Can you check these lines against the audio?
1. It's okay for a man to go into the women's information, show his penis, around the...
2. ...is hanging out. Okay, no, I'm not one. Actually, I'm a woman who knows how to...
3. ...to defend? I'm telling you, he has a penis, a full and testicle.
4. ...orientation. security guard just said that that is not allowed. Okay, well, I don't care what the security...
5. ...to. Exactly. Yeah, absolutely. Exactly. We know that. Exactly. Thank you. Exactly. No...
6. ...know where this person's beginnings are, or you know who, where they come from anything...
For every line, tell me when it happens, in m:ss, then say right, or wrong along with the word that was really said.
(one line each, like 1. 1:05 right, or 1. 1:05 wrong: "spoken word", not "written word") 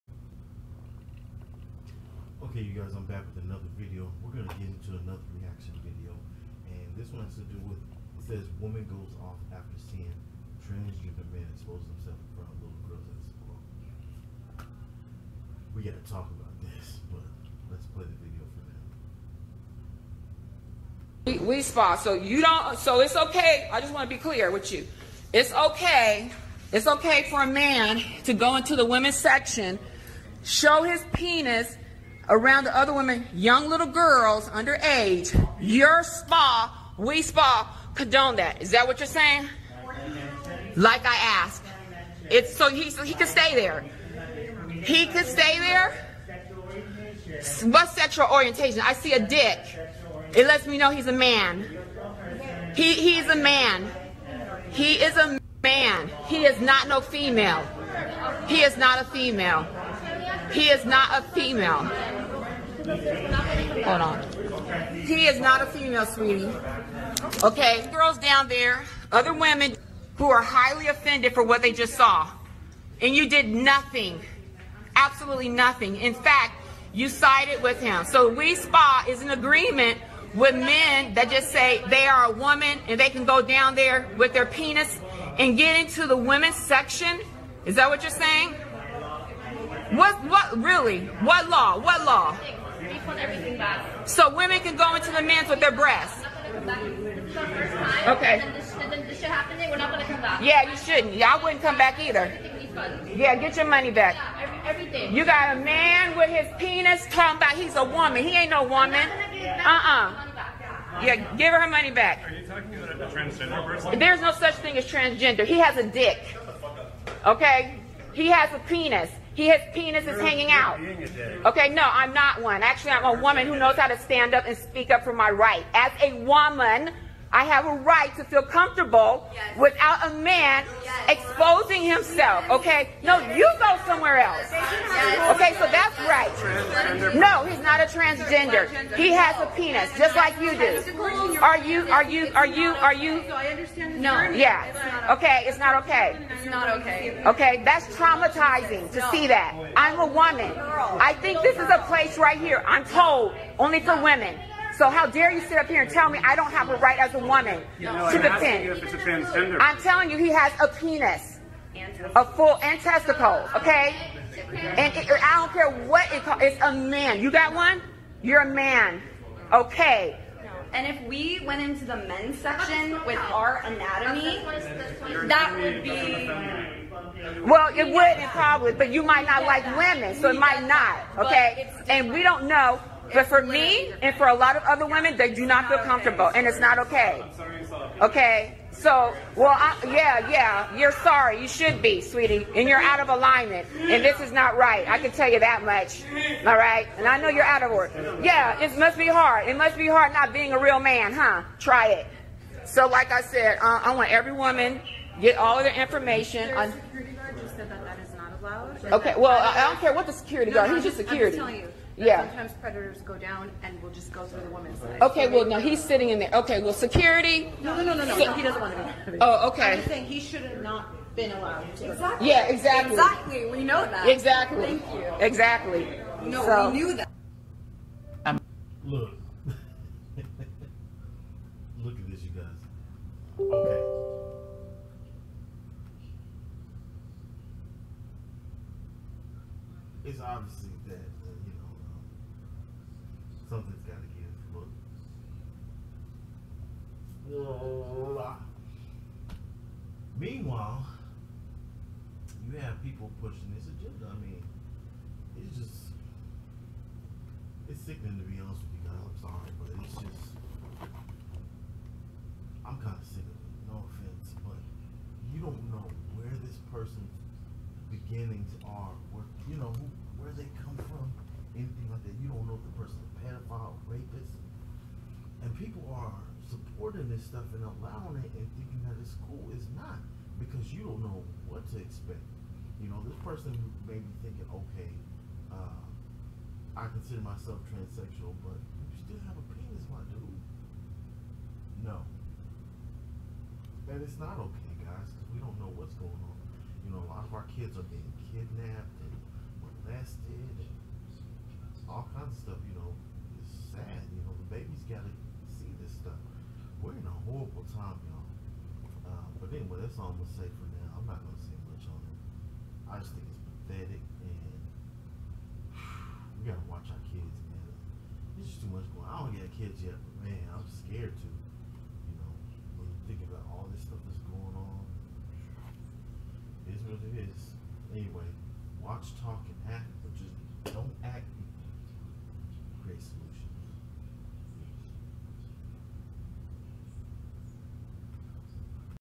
1. 0:26 wrong: "section", not "information"
2. 2:00 right
3. 2:38 right
4. 3:25 wrong: "information", not "orientation"
5. 3:41 wrong: "exactly", not "absolutely"
6. 4:25 right.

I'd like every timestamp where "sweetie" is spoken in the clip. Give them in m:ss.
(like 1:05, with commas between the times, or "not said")
1:06, 3:12.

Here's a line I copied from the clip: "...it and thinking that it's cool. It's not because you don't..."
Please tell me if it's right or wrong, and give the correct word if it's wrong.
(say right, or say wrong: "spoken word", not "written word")
right.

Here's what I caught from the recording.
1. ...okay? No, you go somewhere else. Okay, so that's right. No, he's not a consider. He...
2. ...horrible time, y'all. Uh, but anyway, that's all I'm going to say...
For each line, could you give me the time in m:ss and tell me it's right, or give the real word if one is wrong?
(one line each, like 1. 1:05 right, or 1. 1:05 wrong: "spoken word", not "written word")
1. 2:12 wrong: "transgender", not "consider"
2. 5:07 right.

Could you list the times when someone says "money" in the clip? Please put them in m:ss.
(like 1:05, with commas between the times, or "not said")
1:43, 1:51.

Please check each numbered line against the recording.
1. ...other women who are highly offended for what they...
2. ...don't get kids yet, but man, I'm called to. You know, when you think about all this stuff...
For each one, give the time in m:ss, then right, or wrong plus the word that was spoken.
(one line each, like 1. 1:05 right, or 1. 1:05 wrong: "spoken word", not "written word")
1. 1:09 right
2. 5:19 wrong: "scared", not "called".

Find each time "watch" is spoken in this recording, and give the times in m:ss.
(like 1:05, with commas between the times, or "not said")
5:16, 5:28.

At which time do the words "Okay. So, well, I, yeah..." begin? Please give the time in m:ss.
3:08.